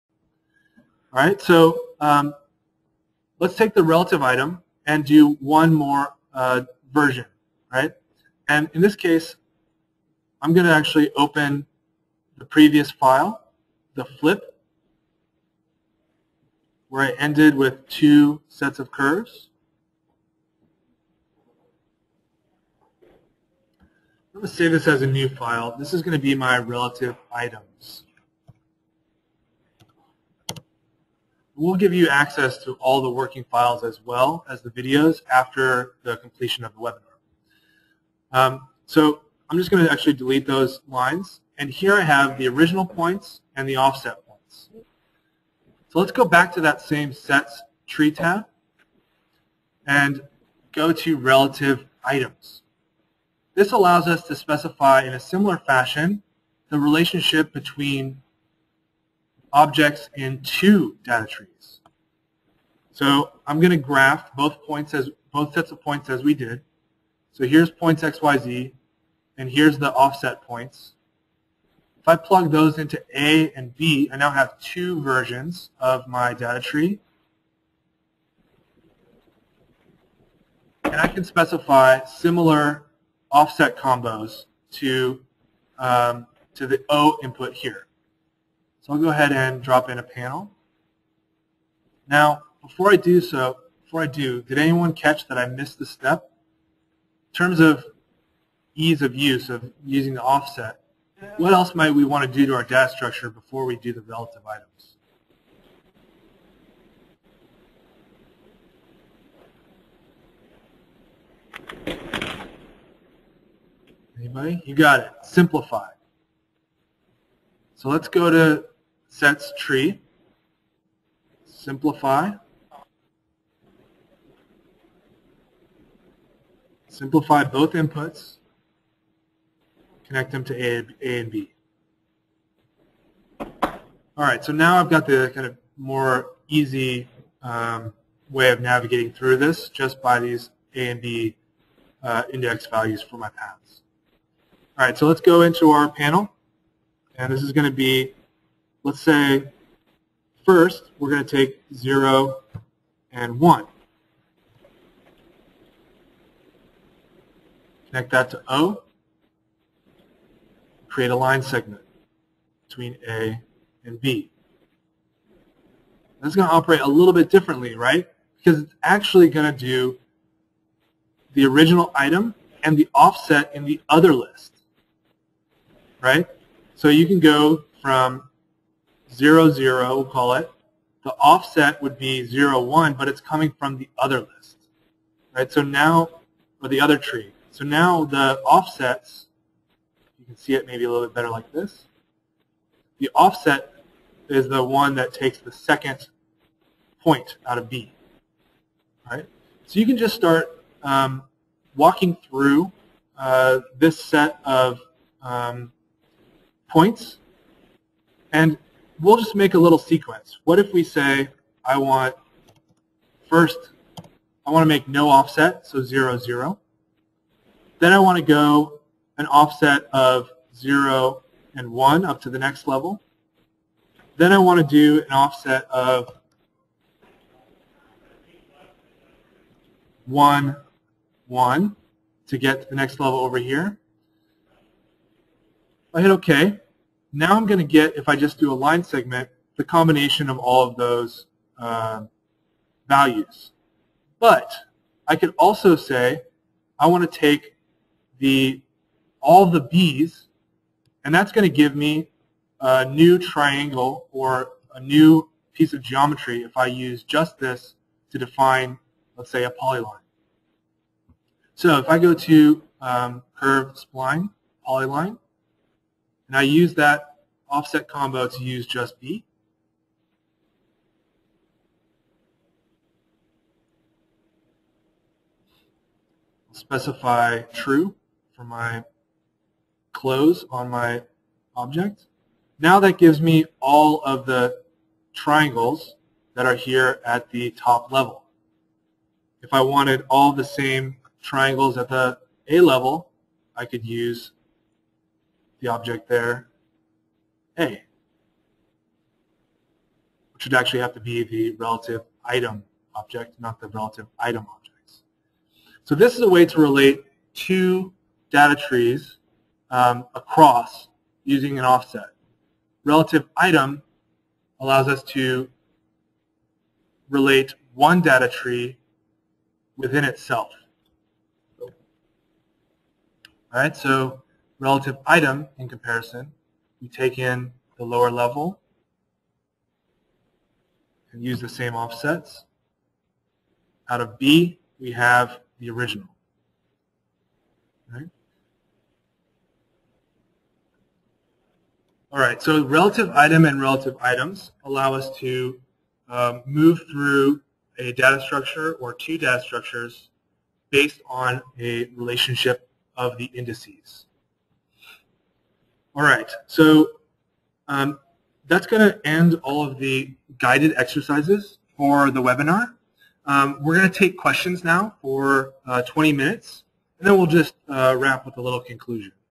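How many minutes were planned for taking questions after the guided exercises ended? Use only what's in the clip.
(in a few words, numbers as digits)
20.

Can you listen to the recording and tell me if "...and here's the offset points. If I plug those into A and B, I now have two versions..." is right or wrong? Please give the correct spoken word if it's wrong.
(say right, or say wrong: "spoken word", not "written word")
right.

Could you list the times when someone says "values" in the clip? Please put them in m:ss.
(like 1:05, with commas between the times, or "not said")
2:22, 4:02.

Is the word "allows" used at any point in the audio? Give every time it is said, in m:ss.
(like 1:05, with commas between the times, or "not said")
0:53, 5:14, 5:44.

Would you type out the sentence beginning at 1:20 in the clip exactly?
And I can specify similar offset combos to, um, to the O input here.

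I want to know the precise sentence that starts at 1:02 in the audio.
So I'm going to graph both points as both sets of points as we did.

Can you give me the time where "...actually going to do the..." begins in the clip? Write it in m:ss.
2:48.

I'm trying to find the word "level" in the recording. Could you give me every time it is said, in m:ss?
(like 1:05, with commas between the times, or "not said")
3:42, 3:52, 4:47, 4:52, 5:28.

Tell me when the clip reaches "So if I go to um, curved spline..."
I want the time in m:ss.
4:21.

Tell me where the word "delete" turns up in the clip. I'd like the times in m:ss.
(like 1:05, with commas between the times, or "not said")
0:40.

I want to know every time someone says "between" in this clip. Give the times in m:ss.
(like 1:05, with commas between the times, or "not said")
0:57, 2:42.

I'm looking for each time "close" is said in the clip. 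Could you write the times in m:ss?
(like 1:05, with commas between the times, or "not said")
4:39.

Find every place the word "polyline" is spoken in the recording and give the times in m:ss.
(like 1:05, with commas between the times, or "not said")
4:19, 4:24.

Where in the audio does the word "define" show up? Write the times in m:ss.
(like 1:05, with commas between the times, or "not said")
4:18.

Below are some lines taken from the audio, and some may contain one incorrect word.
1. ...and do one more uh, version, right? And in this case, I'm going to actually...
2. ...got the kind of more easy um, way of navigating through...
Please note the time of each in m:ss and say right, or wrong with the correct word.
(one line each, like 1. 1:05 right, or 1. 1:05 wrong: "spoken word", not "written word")
1. 0:04 right
2. 2:14 right.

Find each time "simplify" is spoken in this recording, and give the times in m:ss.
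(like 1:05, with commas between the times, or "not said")
1:55, 2:01, 2:06.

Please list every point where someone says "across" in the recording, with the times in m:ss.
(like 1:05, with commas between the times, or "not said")
5:10.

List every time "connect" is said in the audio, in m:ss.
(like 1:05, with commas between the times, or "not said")
2:10, 2:37.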